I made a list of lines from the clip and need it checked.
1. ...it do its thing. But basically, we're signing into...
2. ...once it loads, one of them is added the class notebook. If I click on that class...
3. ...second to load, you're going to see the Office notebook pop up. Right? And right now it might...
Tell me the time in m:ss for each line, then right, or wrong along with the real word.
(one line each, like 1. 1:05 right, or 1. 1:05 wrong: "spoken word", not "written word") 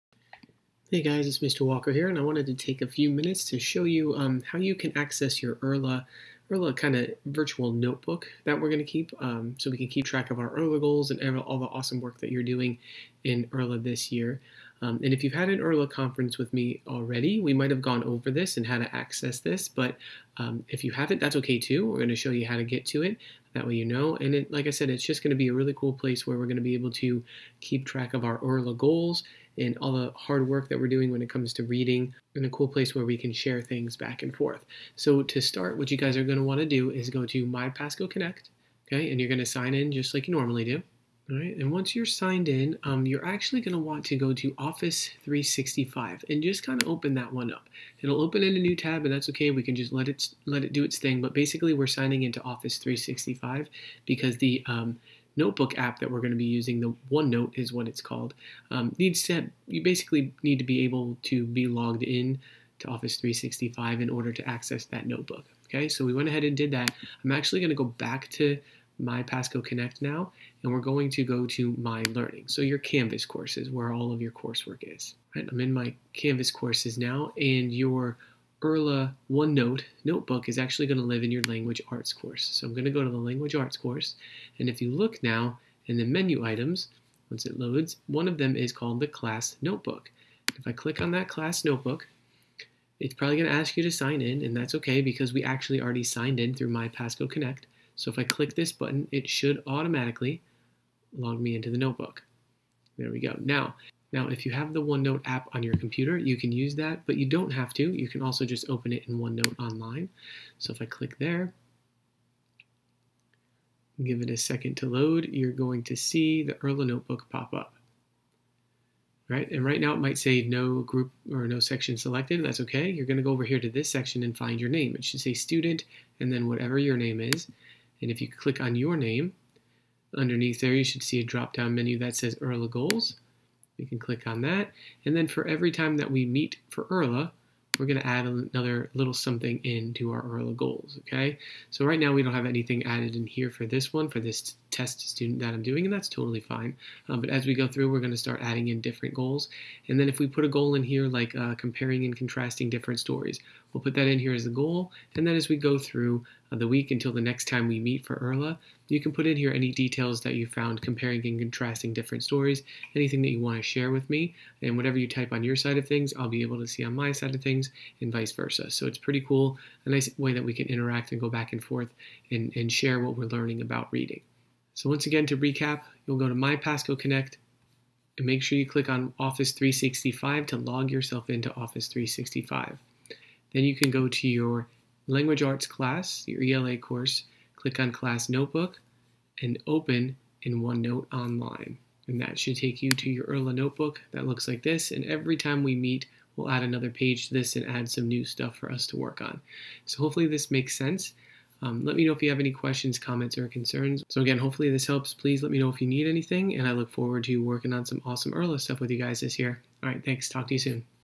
1. 0:50 right
2. 1:27 wrong: "called", not "added"
3. 1:54 wrong: "IRLA", not "Office".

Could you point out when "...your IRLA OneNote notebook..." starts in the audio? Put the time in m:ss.
1:17.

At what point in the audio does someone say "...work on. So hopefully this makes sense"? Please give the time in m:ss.
3:18.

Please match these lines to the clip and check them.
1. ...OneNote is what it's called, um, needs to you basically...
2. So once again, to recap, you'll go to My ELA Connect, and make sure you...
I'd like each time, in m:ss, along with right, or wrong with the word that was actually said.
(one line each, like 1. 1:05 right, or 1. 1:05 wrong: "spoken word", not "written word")
1. 0:57 right
2. 2:54 wrong: "Pasco", not "ELA".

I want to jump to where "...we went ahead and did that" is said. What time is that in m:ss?
1:06.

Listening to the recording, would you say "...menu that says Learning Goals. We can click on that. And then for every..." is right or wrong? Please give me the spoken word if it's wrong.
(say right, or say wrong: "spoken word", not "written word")
wrong: "IRLA", not "Learning".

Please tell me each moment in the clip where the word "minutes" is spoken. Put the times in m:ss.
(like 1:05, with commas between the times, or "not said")
0:03.